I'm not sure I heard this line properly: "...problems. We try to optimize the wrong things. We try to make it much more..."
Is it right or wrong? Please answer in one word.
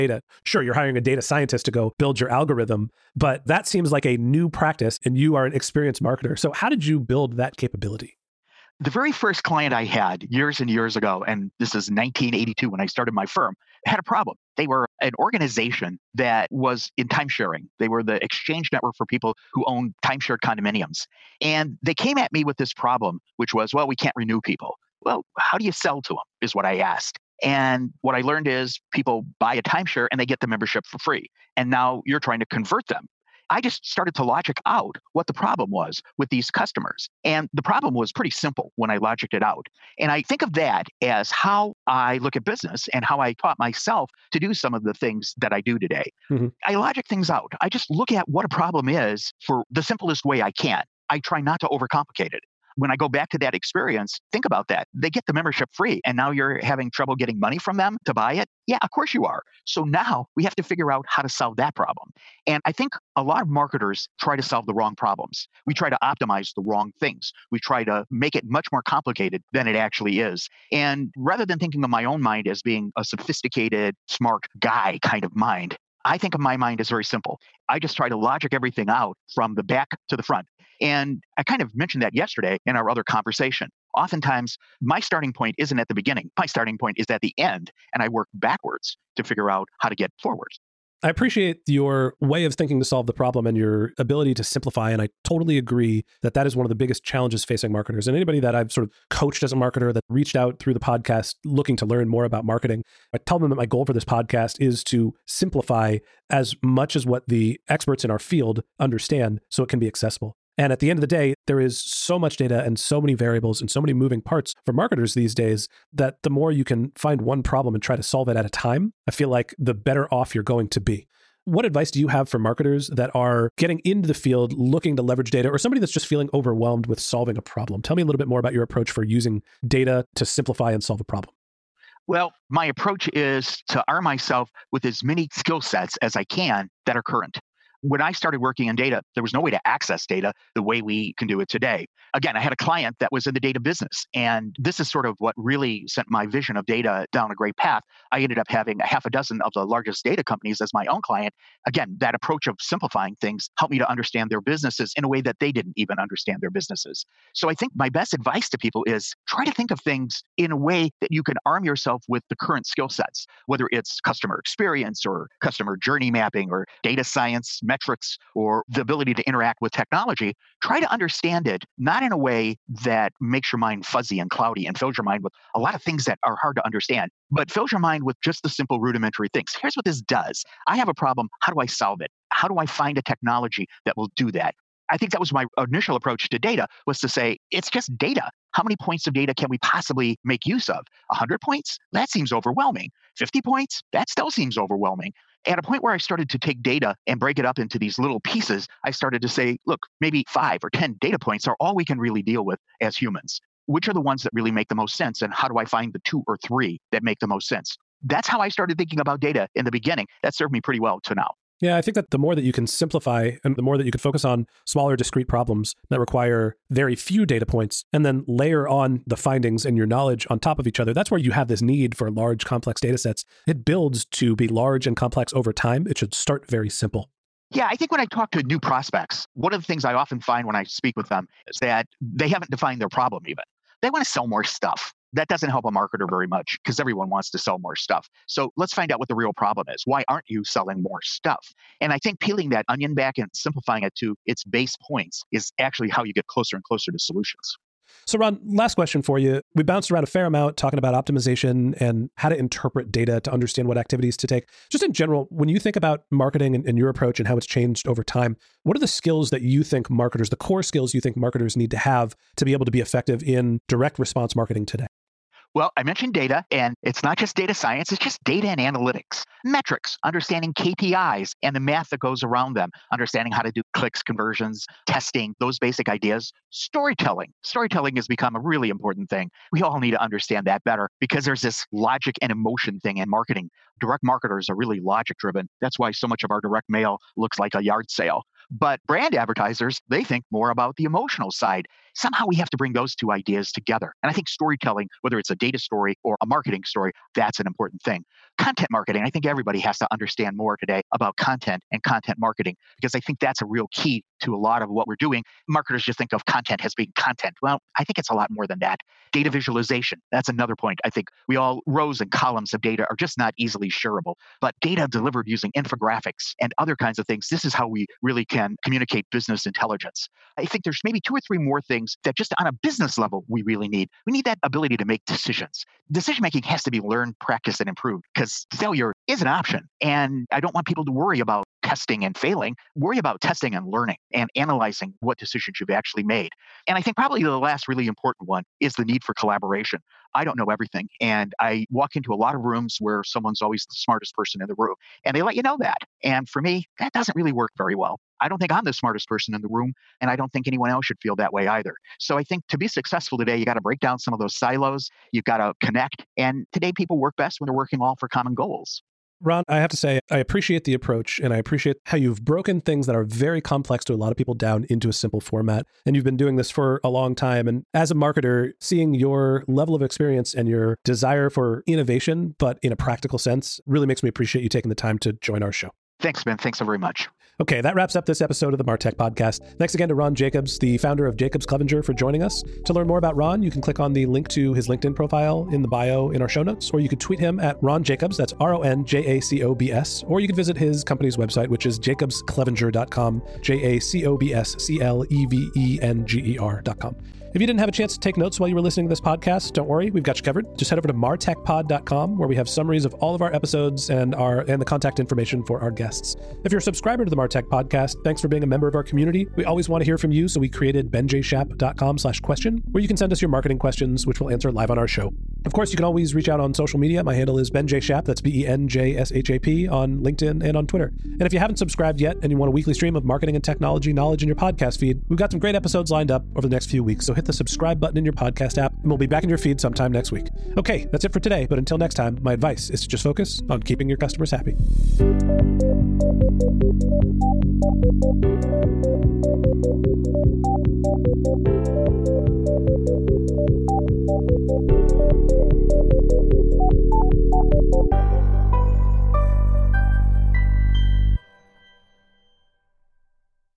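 right.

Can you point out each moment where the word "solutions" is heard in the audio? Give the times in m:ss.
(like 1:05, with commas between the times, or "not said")
4:06.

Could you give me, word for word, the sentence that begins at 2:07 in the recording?
Tell me a little bit more about your approach for using data to simplify and solve a problem.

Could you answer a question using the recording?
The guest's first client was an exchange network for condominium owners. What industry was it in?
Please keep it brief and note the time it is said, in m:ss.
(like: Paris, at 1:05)
time sharing, at 0:17.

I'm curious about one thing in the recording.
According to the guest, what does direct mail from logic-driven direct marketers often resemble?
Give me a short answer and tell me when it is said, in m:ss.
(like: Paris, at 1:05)
a yard sale, at 4:47.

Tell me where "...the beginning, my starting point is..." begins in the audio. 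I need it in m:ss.
1:25.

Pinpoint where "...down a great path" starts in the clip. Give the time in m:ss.
2:27.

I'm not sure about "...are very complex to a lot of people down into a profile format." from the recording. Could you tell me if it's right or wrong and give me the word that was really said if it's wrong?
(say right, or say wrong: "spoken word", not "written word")
wrong: "simple", not "profile".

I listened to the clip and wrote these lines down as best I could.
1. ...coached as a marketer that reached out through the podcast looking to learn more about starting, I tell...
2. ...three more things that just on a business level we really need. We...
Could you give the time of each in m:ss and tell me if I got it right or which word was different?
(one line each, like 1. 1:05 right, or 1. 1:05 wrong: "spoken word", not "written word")
1. 1:39 wrong: "marketing", not "starting"
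2. 5:21 right.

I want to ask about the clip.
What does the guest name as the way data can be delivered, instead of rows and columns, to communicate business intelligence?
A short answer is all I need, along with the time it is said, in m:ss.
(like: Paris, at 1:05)
infographics, at 5:15.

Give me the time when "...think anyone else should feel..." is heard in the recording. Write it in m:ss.
5:50.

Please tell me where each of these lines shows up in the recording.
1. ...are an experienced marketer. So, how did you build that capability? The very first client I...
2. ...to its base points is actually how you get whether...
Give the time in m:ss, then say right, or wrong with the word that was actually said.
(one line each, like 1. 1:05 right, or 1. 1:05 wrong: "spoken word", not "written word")
1. 0:05 right
2. 4:03 wrong: "closer", not "whether".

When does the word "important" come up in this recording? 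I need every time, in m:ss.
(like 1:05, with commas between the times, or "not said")
4:38, 4:57, 5:37.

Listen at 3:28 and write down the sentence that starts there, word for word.
That's how I started thinking about data in the beginning.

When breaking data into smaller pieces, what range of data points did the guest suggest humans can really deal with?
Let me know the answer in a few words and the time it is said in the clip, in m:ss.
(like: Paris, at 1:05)
5 or 10, at 3:20.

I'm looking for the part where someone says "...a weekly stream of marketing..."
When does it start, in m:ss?
7:02.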